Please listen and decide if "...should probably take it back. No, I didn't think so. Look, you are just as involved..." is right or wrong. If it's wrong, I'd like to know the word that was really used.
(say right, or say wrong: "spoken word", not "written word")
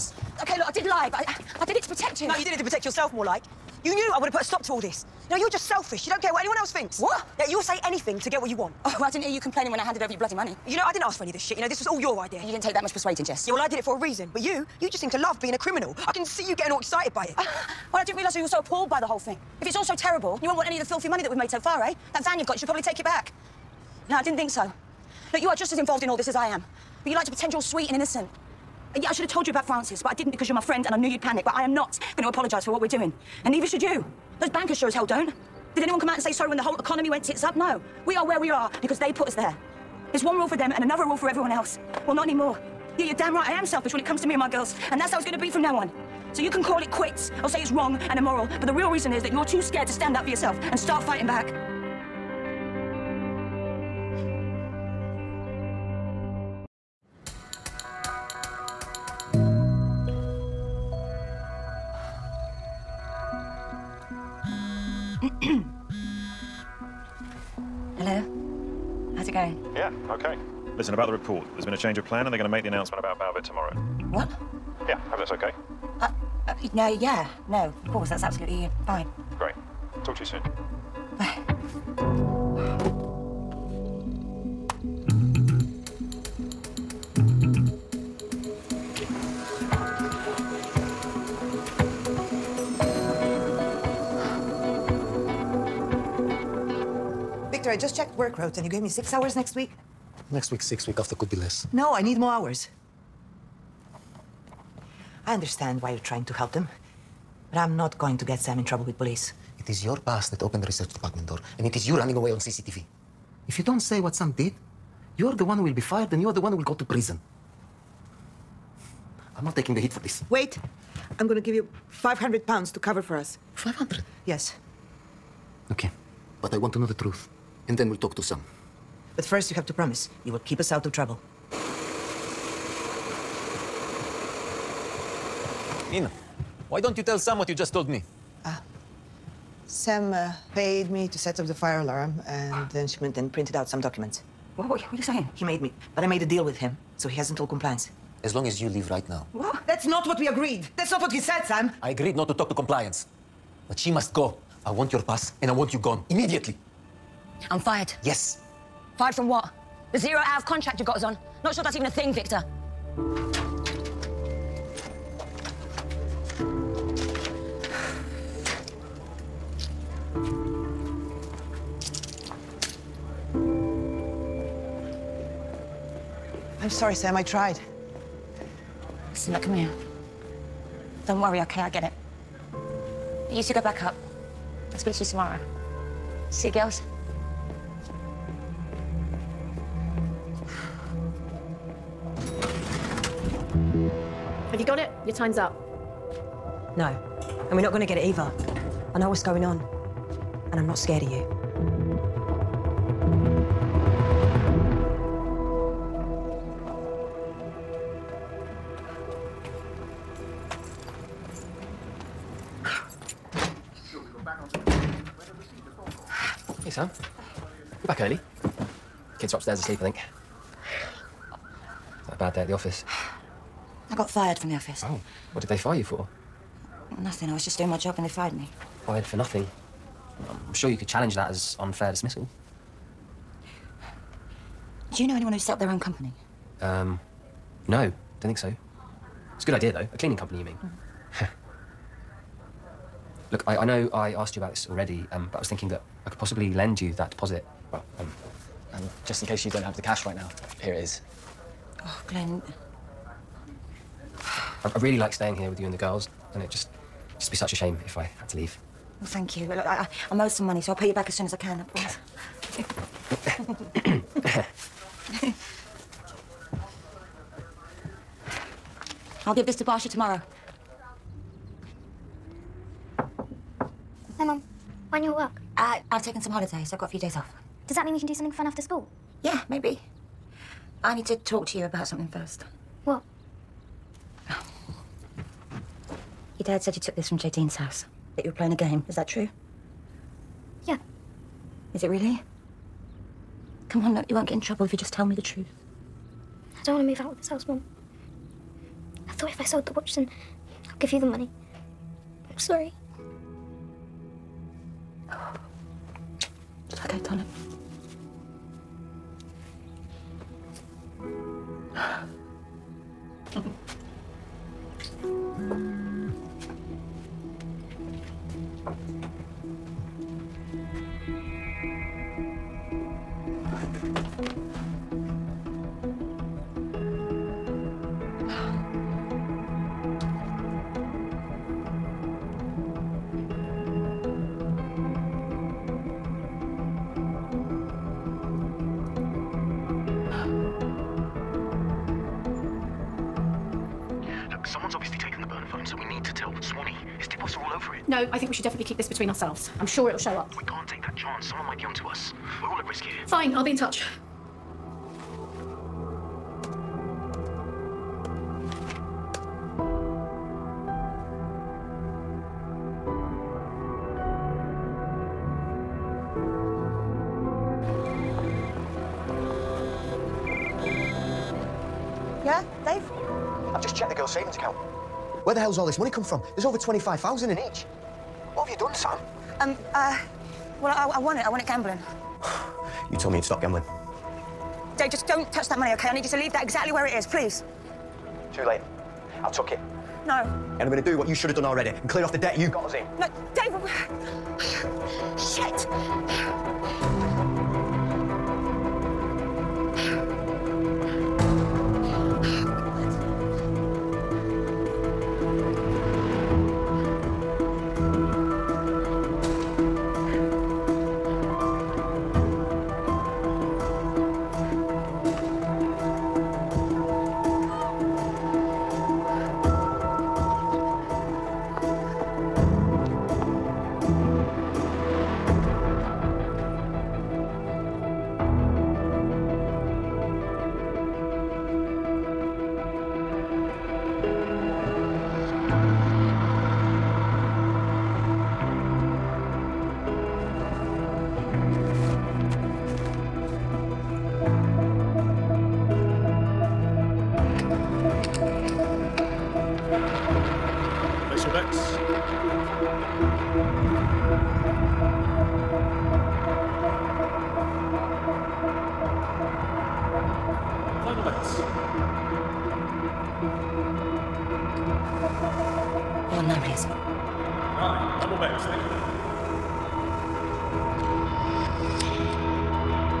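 right.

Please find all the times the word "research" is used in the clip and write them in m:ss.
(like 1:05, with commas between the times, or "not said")
1:50.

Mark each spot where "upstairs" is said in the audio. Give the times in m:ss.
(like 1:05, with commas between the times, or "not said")
3:39.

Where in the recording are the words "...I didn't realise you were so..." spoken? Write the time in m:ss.
0:18.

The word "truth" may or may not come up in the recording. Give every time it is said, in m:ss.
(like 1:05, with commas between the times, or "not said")
2:06, 4:55.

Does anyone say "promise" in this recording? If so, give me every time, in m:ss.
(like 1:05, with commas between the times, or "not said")
2:09, 4:21.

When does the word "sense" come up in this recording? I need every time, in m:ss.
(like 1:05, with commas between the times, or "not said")
not said.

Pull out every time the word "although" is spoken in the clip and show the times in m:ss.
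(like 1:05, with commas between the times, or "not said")
not said.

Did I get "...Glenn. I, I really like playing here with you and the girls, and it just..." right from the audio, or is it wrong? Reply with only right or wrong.
wrong.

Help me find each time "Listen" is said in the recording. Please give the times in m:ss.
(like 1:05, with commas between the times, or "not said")
1:10, 2:59.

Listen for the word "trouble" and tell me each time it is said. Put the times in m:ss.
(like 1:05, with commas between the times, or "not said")
1:48, 2:10, 4:54.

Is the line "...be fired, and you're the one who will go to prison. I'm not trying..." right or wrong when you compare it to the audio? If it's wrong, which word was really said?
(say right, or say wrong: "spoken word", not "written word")
wrong: "taking", not "trying".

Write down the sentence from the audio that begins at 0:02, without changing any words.
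No, you did it to protect yourself, more like.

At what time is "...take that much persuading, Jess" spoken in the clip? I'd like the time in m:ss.
0:12.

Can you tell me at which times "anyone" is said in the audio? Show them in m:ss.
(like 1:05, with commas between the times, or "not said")
0:06, 0:35, 3:55.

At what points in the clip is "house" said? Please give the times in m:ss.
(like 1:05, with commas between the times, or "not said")
4:47, 4:57.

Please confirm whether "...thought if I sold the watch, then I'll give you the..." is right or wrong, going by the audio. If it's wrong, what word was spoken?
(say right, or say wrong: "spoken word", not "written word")
right.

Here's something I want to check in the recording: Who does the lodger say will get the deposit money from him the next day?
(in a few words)
Barsha.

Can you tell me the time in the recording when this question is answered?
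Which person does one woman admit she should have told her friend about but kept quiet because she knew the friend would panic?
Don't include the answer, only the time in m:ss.
0:29.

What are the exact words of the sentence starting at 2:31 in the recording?
I agreed not to talk to compliance.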